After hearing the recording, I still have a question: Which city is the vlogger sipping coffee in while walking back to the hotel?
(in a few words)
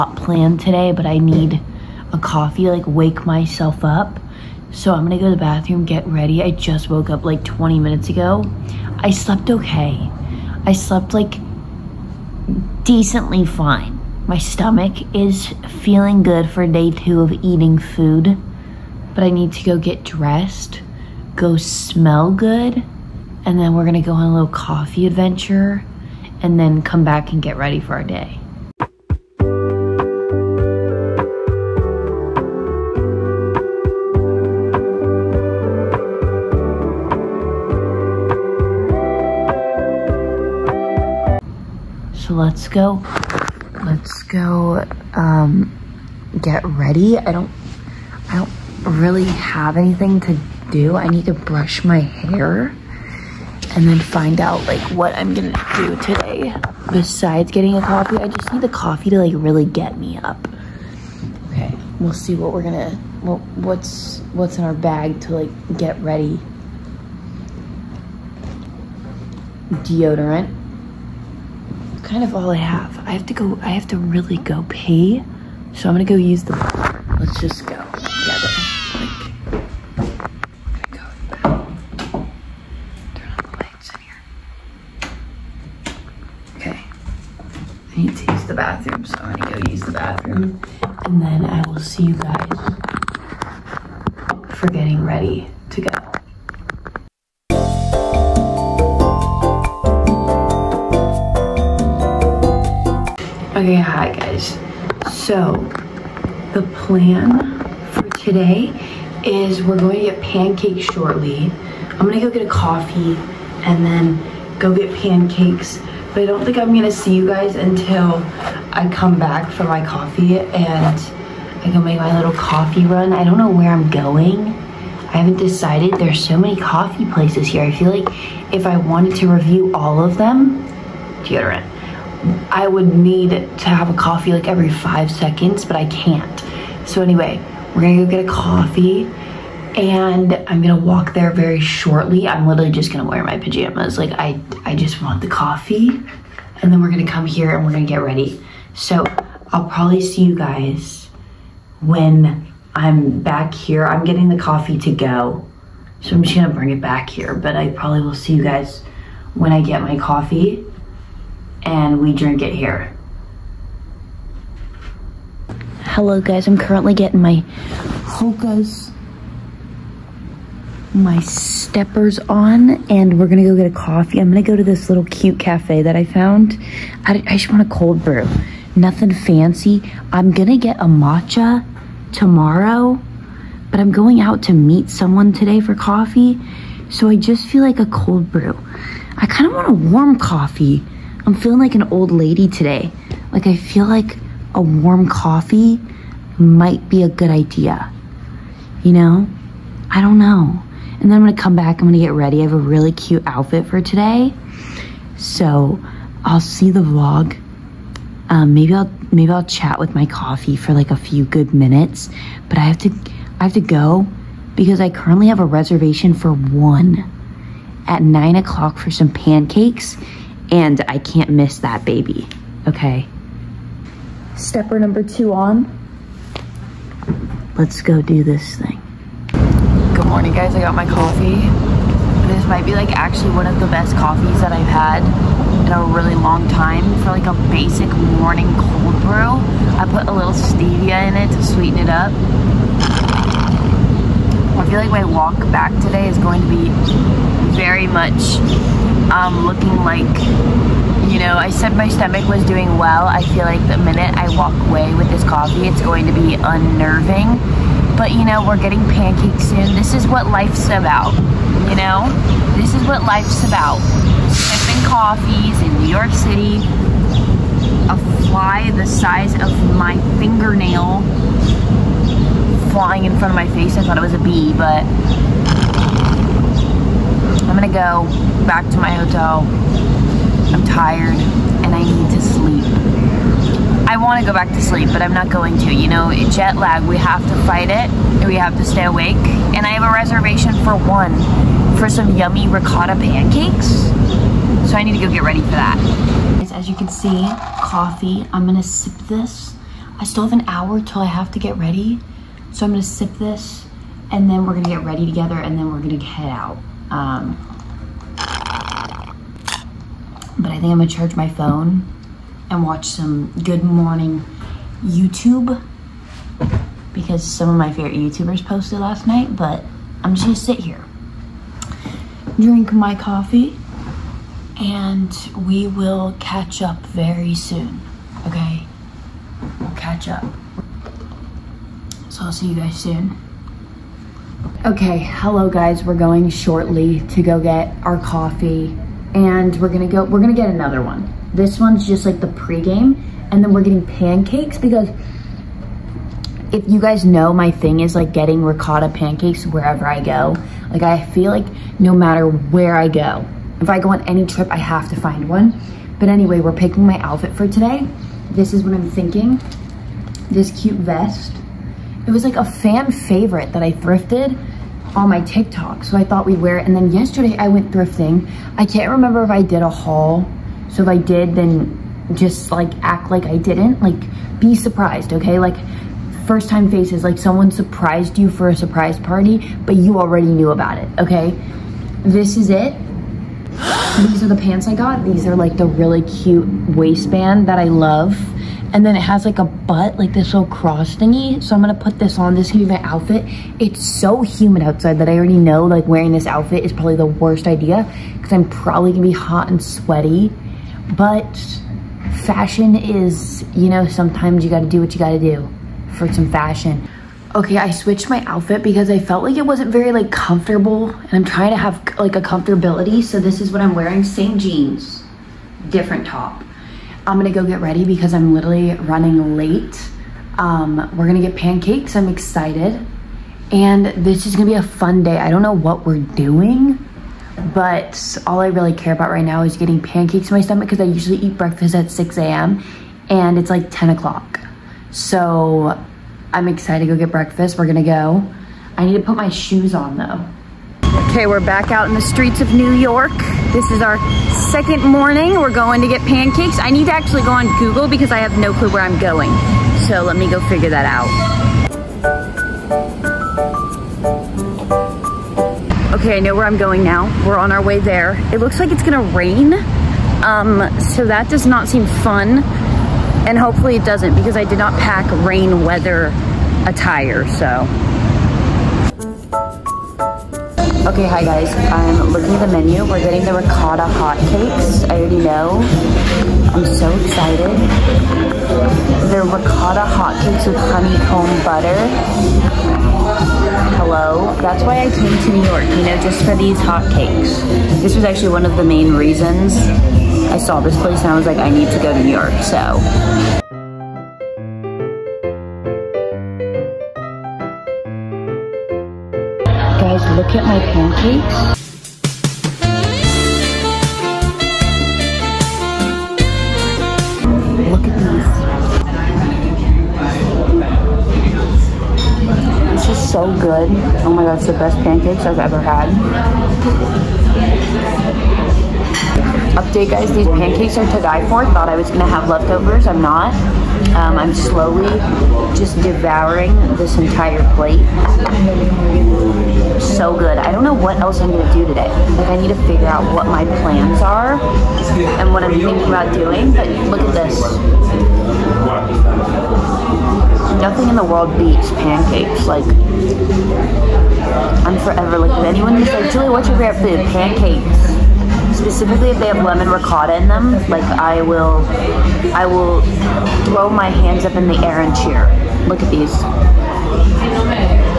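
New York City.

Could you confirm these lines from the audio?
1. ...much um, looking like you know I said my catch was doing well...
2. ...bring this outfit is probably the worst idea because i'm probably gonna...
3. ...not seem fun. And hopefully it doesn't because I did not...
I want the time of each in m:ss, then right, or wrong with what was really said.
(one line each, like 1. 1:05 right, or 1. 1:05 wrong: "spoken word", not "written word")
1. 4:07 wrong: "stomach", not "catch"
2. 6:35 wrong: "wearing", not "bring"
3. 7:41 right.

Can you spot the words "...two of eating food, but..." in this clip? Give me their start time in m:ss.
0:16.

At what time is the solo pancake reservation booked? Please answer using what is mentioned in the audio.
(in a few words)
9 o'clock.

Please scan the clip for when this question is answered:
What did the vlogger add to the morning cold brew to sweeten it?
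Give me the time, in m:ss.
4:00.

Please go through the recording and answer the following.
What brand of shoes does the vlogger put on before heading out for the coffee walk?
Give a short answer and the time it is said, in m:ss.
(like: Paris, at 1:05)
Hoka, at 2:48.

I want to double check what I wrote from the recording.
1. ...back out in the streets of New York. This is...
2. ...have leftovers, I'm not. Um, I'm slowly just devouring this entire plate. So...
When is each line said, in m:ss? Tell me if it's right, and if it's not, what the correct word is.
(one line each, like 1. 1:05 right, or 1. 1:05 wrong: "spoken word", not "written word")
1. 7:21 right
2. 8:42 right.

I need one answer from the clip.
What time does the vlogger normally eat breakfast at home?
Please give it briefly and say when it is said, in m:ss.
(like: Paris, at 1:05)
6 a.m., at 7:11.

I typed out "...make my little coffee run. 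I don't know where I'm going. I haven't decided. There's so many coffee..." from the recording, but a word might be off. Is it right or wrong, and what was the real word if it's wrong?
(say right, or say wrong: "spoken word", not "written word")
right.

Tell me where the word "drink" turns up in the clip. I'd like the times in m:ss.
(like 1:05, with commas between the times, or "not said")
2:42, 5:22.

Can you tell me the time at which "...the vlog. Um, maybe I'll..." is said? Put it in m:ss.
3:26.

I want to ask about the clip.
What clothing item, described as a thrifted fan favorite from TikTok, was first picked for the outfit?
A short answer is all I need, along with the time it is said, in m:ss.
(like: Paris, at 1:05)
Vest, at 6:00.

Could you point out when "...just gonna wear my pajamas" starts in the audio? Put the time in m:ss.
2:22.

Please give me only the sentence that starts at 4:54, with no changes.
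So I need to go get ready for that.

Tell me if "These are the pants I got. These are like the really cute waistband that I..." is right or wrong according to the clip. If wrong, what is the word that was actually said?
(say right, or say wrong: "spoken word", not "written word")
right.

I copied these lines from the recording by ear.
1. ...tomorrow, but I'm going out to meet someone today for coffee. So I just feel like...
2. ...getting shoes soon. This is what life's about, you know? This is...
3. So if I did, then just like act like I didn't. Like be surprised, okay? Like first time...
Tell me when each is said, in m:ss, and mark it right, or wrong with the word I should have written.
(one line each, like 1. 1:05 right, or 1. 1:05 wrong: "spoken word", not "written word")
1. 3:02 right
2. 4:18 wrong: "pancakes", not "shoes"
3. 6:10 right.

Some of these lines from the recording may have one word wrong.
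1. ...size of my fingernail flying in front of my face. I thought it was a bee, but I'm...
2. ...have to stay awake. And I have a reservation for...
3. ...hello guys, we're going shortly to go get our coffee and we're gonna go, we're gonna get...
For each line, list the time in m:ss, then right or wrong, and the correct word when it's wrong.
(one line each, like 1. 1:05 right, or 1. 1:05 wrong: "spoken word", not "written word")
1. 4:28 right
2. 4:48 right
3. 5:34 right.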